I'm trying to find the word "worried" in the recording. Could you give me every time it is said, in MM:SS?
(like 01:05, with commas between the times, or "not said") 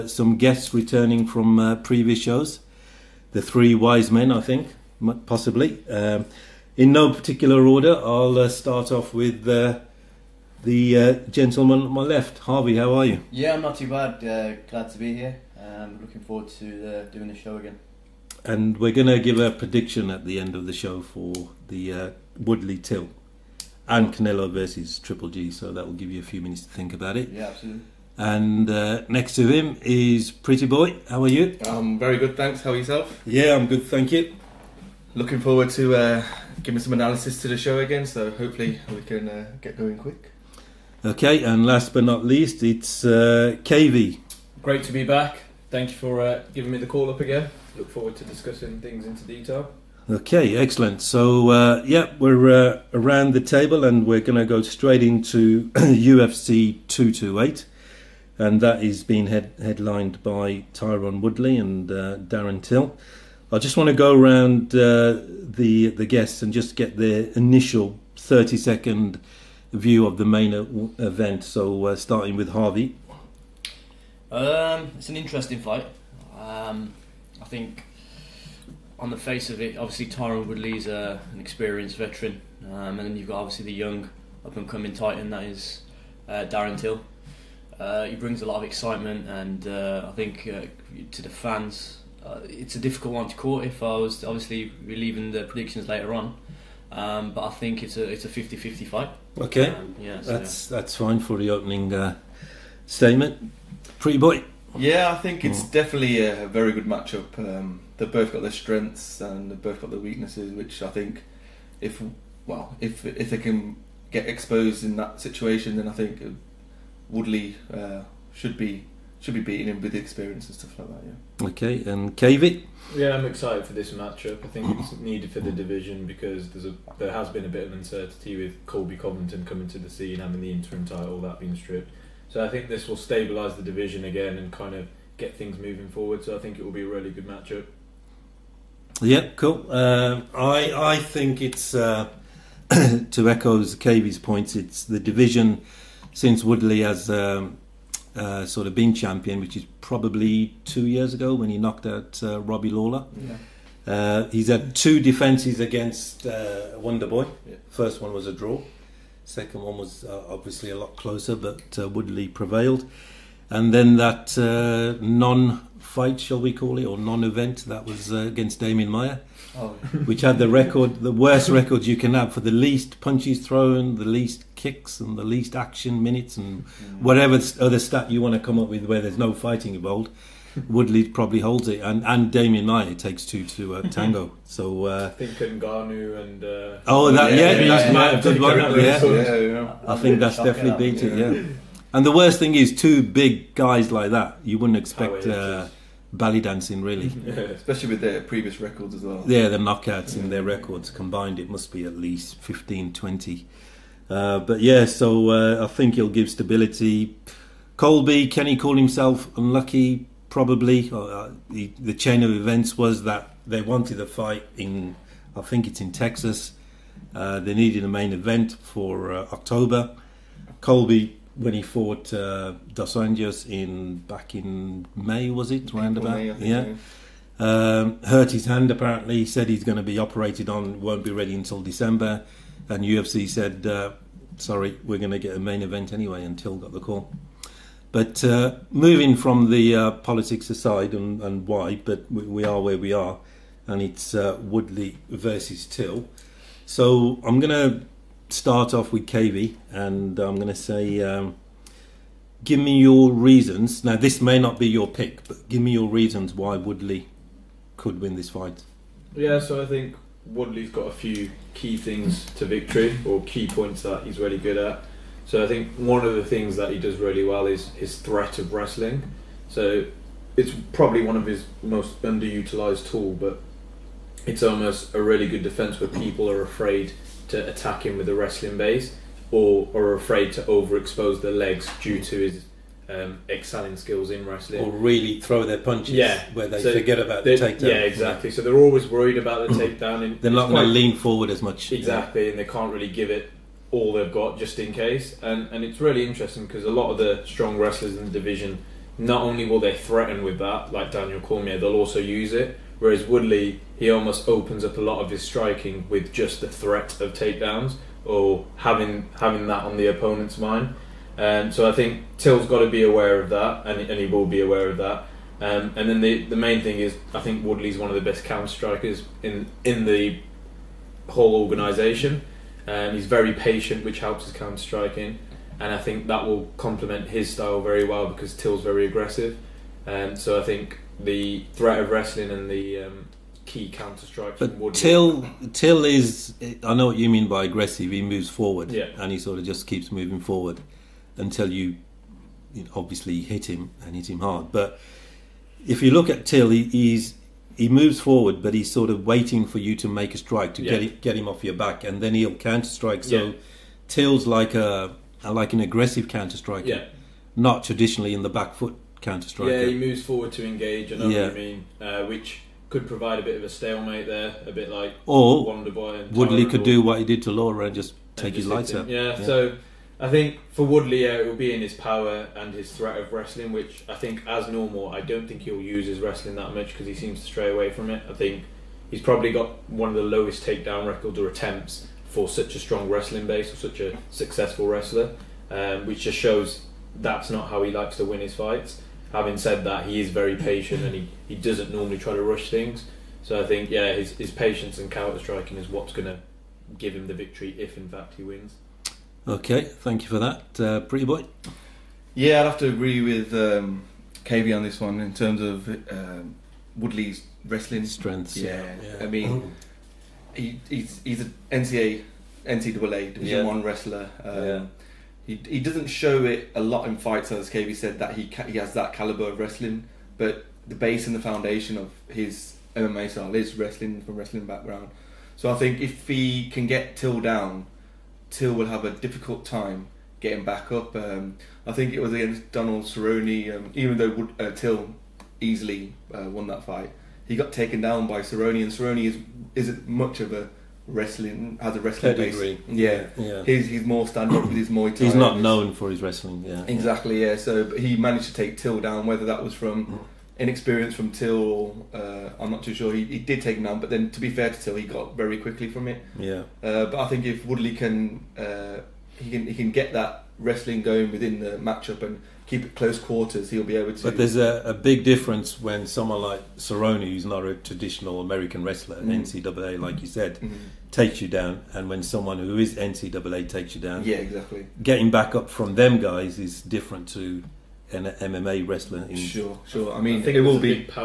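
04:48.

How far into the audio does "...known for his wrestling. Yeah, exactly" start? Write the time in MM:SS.
07:25.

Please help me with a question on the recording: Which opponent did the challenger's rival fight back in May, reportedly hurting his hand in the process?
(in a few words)
Dos Anjos.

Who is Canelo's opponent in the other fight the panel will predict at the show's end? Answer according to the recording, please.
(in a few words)
Triple G.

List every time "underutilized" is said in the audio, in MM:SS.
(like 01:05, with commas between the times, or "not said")
04:32.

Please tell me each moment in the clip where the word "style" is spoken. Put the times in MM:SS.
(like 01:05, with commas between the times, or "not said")
05:27, 07:03.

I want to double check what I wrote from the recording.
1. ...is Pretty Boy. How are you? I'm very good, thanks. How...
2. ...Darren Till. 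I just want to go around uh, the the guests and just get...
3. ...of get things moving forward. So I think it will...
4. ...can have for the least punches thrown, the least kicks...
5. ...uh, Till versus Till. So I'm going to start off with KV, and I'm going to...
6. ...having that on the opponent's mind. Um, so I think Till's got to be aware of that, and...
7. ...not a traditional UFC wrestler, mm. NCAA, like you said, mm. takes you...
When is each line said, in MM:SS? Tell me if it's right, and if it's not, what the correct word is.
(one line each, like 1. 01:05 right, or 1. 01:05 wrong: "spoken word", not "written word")
1. 00:29 right
2. 01:02 right
3. 02:14 right
4. 02:51 right
5. 04:04 wrong: "Woodley", not "Till"
6. 05:09 right
7. 07:47 wrong: "American", not "UFC".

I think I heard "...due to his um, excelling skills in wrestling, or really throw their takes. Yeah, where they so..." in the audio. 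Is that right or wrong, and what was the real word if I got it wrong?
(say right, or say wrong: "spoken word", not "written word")
wrong: "punches", not "takes".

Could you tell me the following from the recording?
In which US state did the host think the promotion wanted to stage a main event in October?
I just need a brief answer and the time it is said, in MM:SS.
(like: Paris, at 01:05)
Texas, at 03:35.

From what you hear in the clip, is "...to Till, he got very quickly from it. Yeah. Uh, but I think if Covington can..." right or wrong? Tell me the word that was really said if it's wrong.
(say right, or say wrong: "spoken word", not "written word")
wrong: "Woodley", not "Covington".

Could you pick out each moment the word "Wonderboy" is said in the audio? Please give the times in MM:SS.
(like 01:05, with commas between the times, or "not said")
02:36, 06:05.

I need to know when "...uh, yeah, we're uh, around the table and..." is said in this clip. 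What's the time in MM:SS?
00:51.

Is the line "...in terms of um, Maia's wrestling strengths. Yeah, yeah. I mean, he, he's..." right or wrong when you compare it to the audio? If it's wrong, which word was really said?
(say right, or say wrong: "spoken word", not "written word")
wrong: "Woodley", not "Maia".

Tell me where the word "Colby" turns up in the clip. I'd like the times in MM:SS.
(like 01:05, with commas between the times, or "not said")
02:08, 03:27, 03:40.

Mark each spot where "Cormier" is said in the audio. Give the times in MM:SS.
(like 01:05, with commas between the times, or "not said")
05:01.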